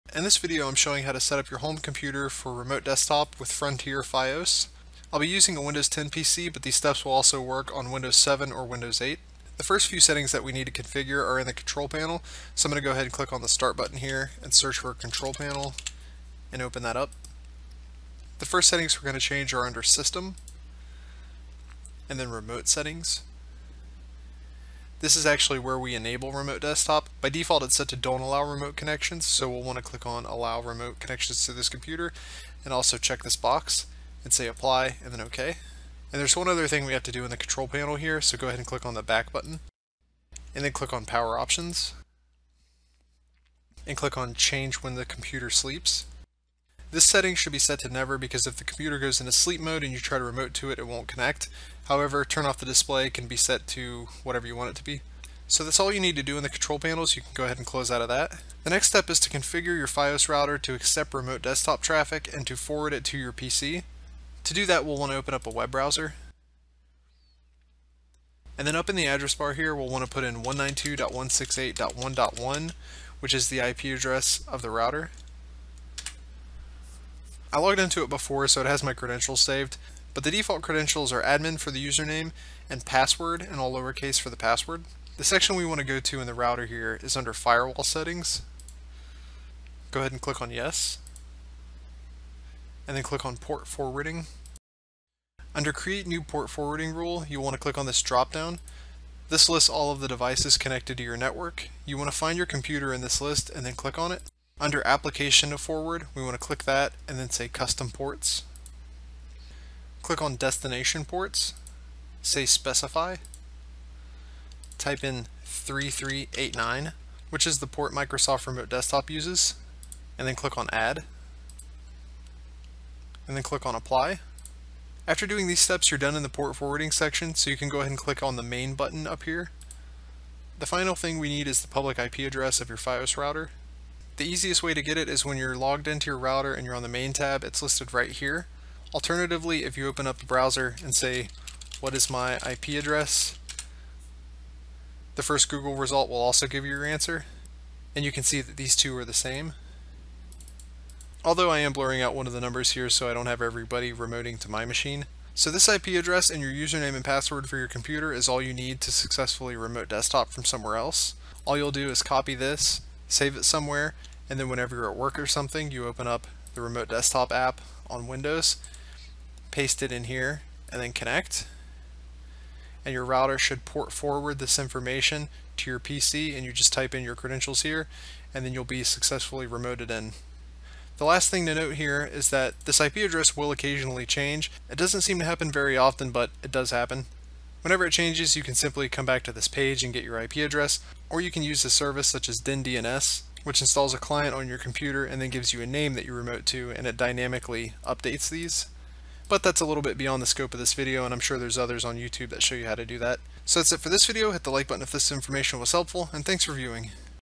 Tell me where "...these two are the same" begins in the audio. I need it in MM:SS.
02:28.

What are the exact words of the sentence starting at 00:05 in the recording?
I'll be using a Windows 10 PC, but these steps will also work on Windows 7 or Windows 8.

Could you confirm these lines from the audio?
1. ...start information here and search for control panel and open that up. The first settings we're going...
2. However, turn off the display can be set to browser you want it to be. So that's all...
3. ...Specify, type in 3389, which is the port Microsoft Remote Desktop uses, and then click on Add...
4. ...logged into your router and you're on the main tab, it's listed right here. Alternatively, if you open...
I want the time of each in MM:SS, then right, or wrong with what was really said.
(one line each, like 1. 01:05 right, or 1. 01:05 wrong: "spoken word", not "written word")
1. 00:13 wrong: "button", not "information"
2. 00:51 wrong: "whatever", not "browser"
3. 01:52 right
4. 02:15 right.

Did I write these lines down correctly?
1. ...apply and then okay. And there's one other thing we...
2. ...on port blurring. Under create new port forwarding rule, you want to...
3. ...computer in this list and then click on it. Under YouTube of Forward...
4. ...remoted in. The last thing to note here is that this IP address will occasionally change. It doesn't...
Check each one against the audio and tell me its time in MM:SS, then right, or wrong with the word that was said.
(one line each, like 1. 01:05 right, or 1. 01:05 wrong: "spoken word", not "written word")
1. 00:34 right
2. 01:33 wrong: "forwarding", not "blurring"
3. 01:42 wrong: "Application", not "YouTube"
4. 02:59 right.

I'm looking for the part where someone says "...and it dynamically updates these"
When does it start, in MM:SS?
03:16.